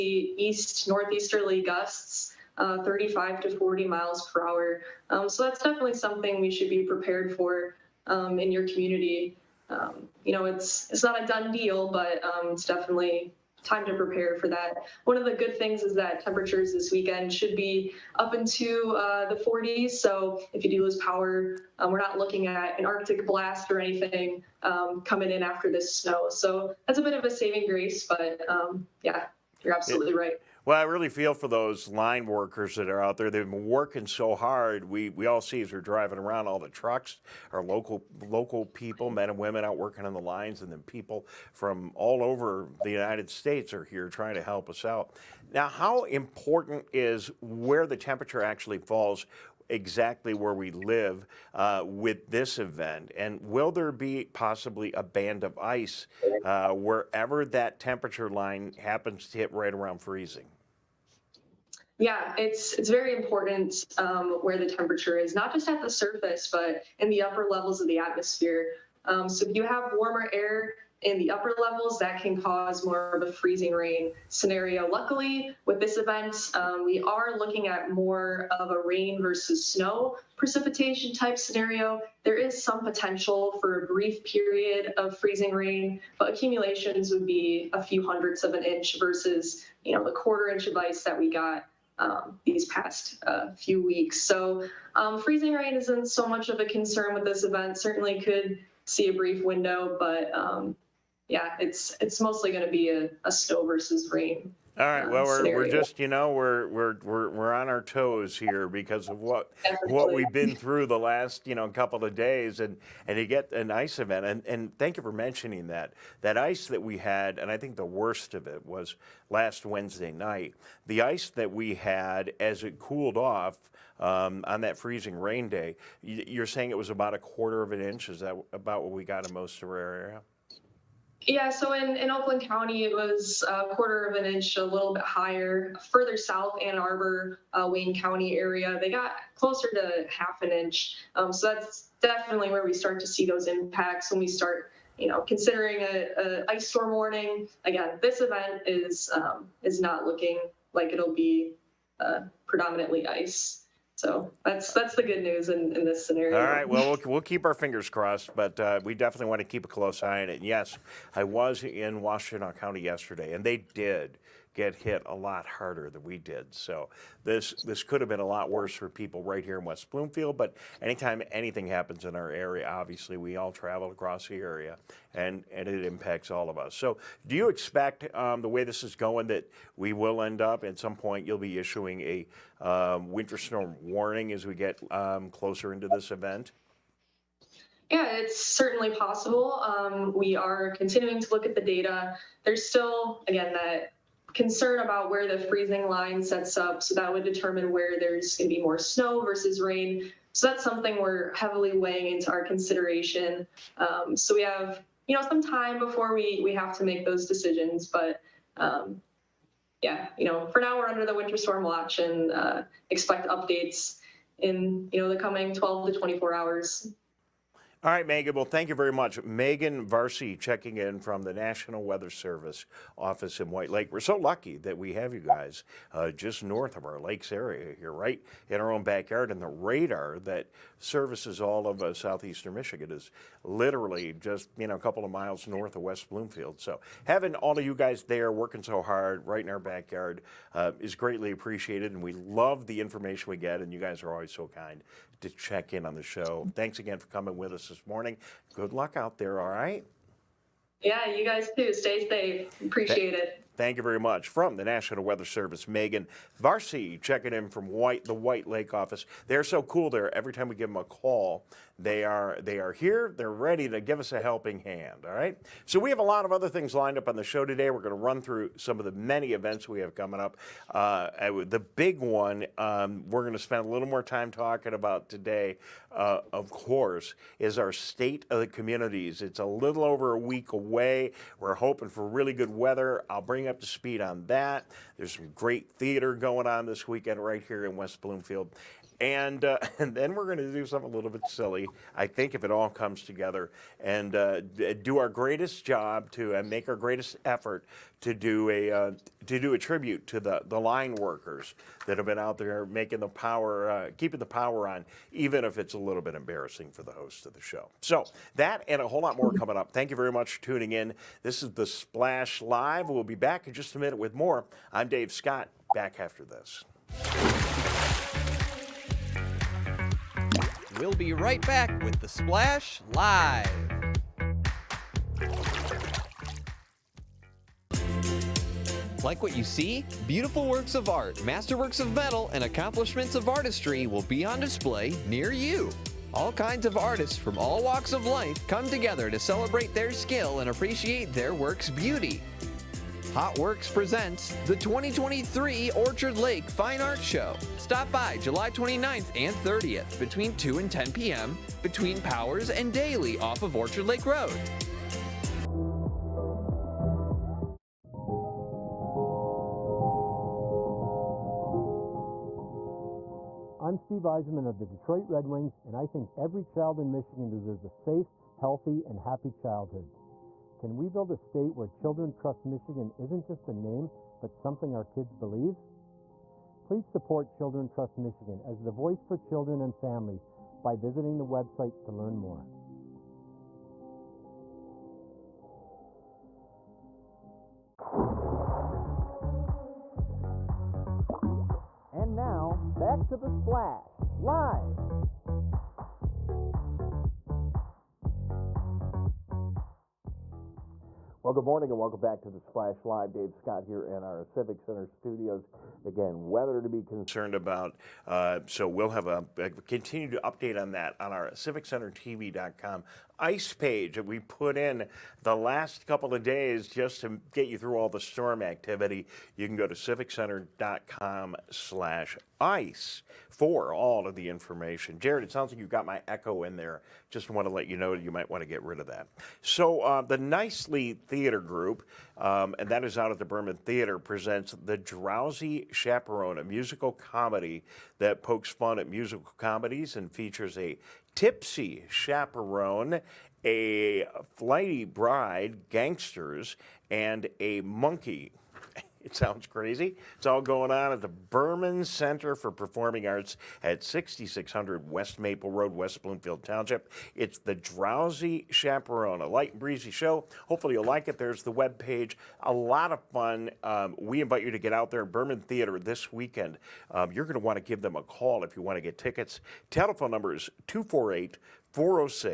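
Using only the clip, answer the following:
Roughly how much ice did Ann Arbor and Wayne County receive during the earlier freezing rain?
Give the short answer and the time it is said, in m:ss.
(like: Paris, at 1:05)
half an inch, at 2:20.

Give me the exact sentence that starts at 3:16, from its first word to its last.
So that would determine where there's going to be more snow versus rain.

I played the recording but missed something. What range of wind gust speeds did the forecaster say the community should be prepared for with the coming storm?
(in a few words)
35 to 40 mph.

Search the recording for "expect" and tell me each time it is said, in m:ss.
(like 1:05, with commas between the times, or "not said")
2:57, 3:32.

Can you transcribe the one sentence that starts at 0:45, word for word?
Now, how important is where the temperature actually falls exactly where we live uh, with this event?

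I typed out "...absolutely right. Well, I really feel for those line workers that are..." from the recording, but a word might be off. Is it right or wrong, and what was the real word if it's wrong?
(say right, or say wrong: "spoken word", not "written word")
right.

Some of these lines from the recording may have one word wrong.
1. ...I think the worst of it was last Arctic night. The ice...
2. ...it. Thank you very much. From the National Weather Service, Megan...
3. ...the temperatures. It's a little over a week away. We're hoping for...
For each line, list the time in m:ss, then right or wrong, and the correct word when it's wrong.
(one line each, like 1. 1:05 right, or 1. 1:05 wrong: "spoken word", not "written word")
1. 1:57 wrong: "Wednesday", not "Arctic"
2. 4:13 right
3. 4:38 wrong: "communities", not "temperatures".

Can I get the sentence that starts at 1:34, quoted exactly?
So um, freezing rain isn't so much of a concern with this event.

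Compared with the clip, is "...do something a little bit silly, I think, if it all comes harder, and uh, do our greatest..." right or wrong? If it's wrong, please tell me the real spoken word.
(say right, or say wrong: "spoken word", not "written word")
wrong: "together", not "harder".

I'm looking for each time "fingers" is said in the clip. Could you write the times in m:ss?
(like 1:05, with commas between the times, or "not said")
2:37.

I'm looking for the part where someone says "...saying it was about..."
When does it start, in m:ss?
2:06.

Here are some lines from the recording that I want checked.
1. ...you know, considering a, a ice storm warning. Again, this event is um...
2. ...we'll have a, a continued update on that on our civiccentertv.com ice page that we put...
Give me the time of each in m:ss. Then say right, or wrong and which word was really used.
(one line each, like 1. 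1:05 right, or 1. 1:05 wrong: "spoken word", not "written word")
1. 2:24 right
2. 6:48 right.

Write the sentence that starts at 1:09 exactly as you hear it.
Um, so if you have warmer air in the upper levels, that can cause more of a freezing rain scenario.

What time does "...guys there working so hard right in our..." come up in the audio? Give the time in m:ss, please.
3:57.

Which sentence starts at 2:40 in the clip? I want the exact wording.
And yes, I was in Washtenaw County yesterday, and they did get hit a lot harder than we did.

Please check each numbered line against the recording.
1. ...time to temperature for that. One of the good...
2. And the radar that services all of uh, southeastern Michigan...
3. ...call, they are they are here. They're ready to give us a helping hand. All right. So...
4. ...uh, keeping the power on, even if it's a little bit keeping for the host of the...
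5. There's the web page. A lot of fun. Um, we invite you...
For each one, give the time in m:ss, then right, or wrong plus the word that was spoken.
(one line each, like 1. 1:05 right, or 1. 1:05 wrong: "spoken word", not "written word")
1. 0:13 wrong: "prepare", not "temperature"
2. 3:49 right
3. 4:20 right
4. 5:03 wrong: "embarrassing", not "keeping"
5. 7:41 right.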